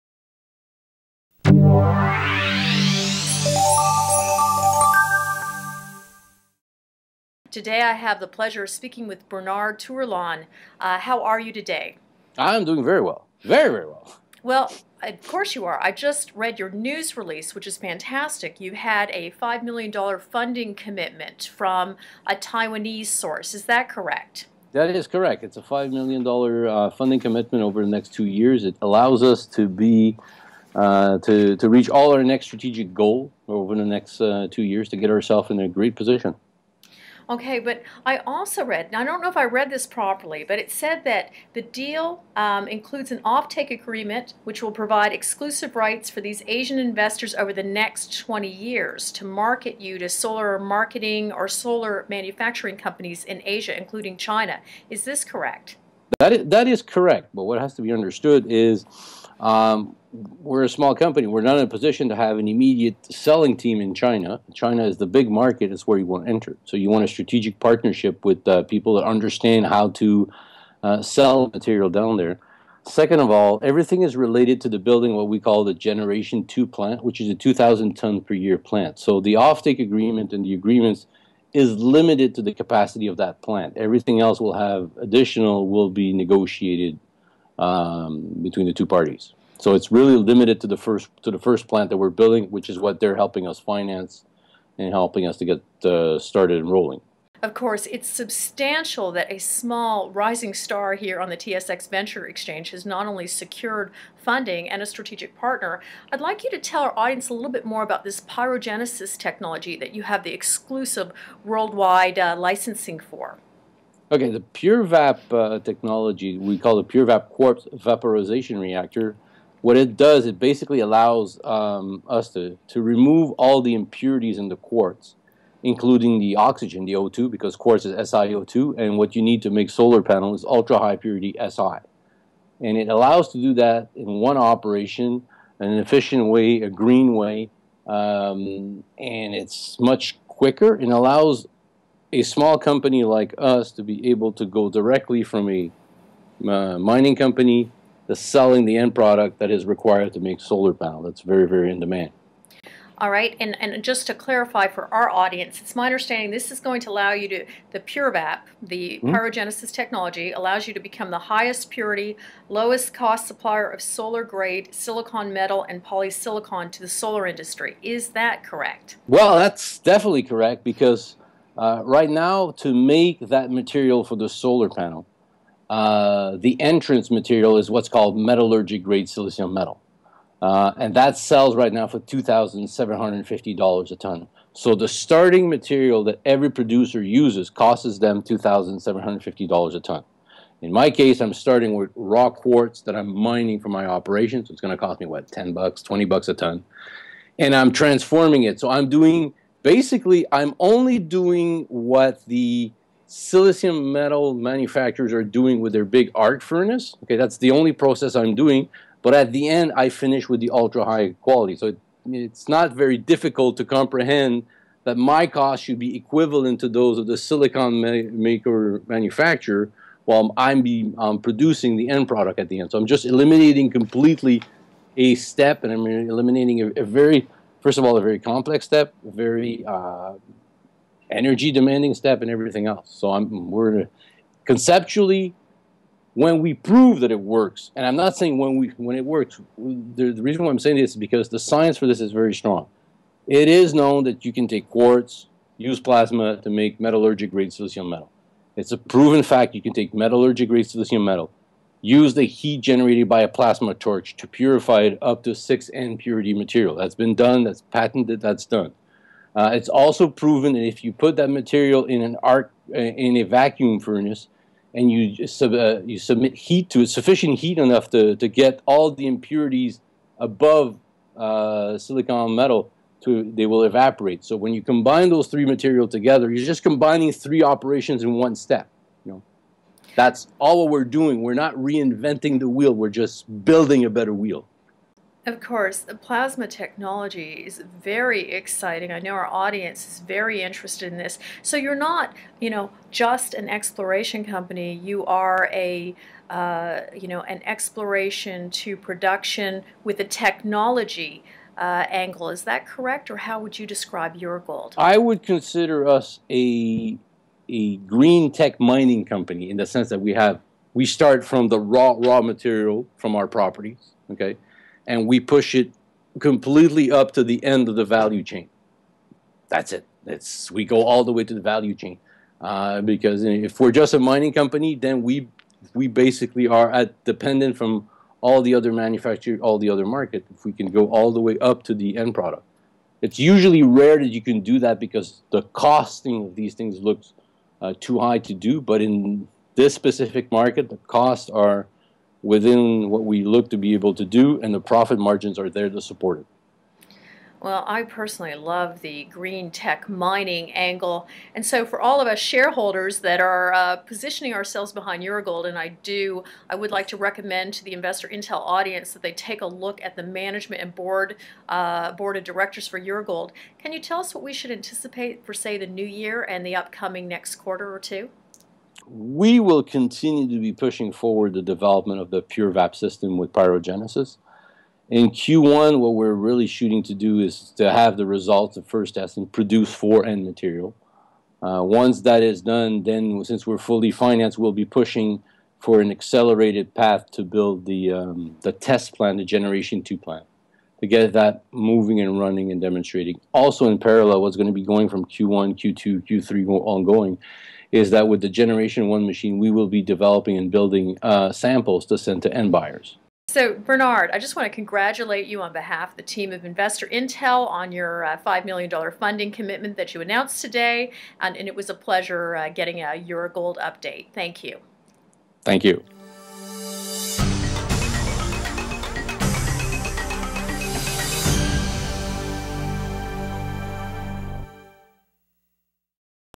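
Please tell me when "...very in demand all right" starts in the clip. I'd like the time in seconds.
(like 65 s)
151 s.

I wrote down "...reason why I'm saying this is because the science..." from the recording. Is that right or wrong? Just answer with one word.
right.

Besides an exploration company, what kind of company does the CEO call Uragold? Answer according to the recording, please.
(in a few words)
green tech mining company.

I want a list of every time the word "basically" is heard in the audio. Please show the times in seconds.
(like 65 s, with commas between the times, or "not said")
120 s, 199 s, 325 s.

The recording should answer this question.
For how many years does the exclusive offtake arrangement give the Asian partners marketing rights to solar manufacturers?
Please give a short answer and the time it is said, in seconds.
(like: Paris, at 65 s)
20, at 48 s.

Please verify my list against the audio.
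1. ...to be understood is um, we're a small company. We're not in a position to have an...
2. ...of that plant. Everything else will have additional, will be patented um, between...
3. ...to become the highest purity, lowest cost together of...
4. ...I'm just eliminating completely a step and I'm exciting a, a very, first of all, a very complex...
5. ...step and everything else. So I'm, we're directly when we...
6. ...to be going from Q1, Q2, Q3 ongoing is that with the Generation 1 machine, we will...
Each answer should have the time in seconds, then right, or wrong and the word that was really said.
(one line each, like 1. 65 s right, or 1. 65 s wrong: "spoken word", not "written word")
1. 57 s right
2. 83 s wrong: "negotiated", not "patented"
3. 160 s wrong: "supplier", not "together"
4. 222 s wrong: "eliminating", not "exciting"
5. 231 s wrong: "conceptually", not "directly"
6. 394 s right.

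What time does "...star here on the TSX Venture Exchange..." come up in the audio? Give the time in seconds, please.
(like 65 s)
100 s.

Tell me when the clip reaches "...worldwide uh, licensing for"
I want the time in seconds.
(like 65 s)
111 s.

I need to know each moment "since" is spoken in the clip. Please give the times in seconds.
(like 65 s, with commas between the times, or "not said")
383 s.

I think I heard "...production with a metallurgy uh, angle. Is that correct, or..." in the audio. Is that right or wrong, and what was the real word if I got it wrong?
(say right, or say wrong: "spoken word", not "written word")
wrong: "technology", not "metallurgy".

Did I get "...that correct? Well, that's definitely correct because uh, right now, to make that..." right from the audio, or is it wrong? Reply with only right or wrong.
right.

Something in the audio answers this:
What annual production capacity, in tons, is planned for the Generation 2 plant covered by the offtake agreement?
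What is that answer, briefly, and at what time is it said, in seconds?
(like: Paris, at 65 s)
2,000 tons, at 77 s.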